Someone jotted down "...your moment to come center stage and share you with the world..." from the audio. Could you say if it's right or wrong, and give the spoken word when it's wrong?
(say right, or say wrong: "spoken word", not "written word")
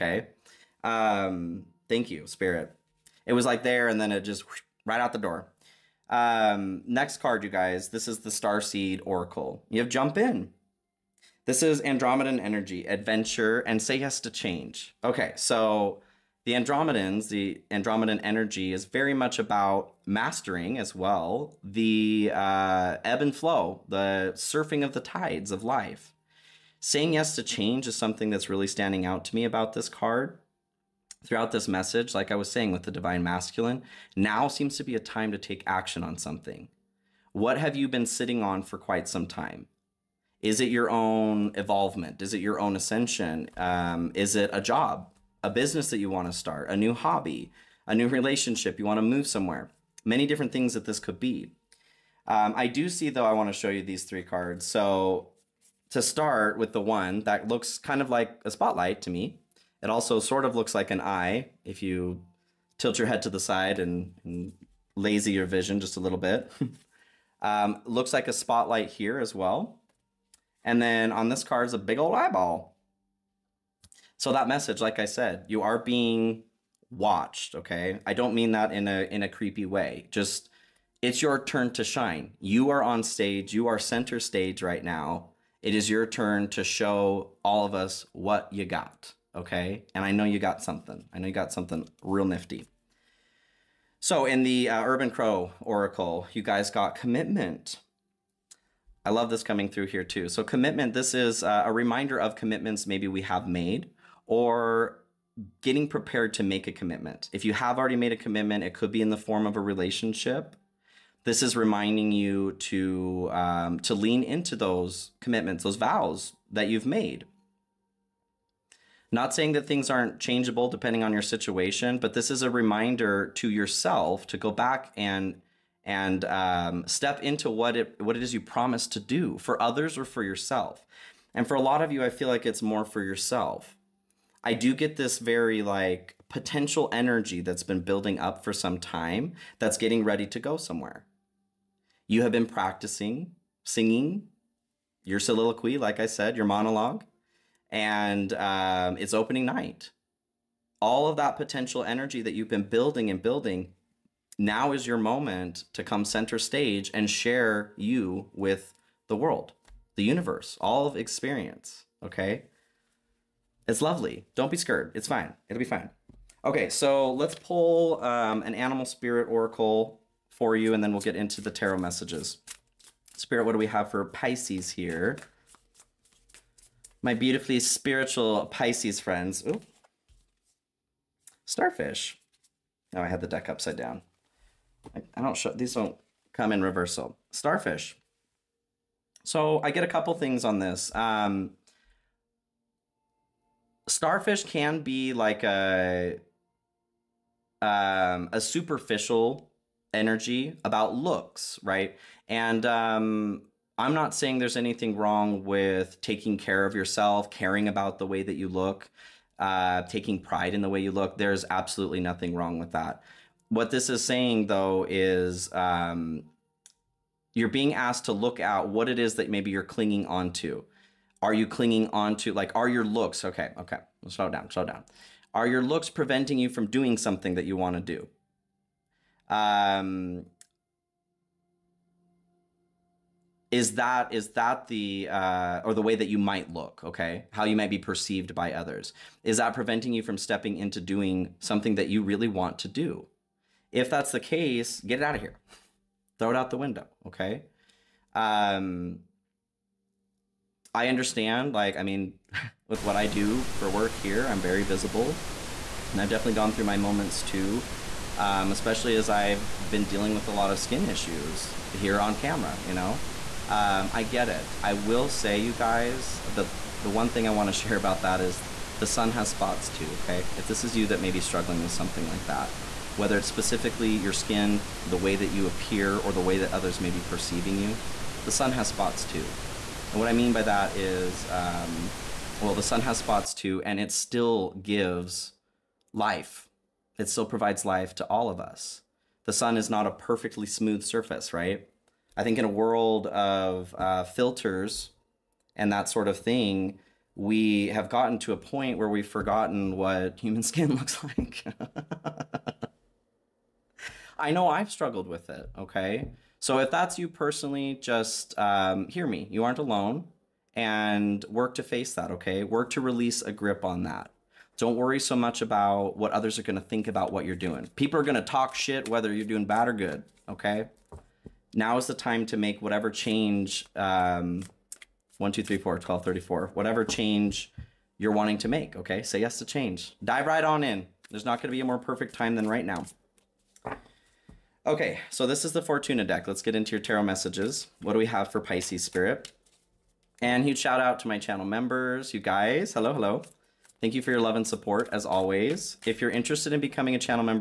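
right.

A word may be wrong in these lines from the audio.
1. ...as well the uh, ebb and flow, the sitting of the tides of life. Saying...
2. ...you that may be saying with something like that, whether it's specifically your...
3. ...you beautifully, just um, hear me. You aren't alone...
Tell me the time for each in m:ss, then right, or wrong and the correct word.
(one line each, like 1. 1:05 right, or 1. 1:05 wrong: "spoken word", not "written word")
1. 0:20 wrong: "surfing", not "sitting"
2. 4:30 wrong: "struggling", not "saying"
3. 5:06 wrong: "personally", not "beautifully".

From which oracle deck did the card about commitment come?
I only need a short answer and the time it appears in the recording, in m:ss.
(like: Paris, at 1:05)
Urban Crow Oracle, at 1:34.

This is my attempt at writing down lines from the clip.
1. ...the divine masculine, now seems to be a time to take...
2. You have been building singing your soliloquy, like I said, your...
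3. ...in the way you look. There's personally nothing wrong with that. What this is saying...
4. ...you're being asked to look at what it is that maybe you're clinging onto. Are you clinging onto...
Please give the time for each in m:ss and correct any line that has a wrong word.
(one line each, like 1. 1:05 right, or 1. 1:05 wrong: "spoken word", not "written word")
1. 0:32 right
2. 2:22 wrong: "practicing", not "building"
3. 3:30 wrong: "absolutely", not "personally"
4. 3:37 right.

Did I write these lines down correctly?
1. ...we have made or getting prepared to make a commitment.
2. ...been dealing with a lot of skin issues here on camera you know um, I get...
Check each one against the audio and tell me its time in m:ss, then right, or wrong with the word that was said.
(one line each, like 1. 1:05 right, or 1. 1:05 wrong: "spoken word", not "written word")
1. 1:43 right
2. 4:19 right.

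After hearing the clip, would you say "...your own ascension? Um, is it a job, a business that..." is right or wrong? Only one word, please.
right.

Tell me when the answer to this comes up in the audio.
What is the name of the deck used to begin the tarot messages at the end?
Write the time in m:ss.
5:35.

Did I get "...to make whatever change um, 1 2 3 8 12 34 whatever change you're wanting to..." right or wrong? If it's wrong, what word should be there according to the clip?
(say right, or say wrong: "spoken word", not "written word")
wrong: "4", not "8".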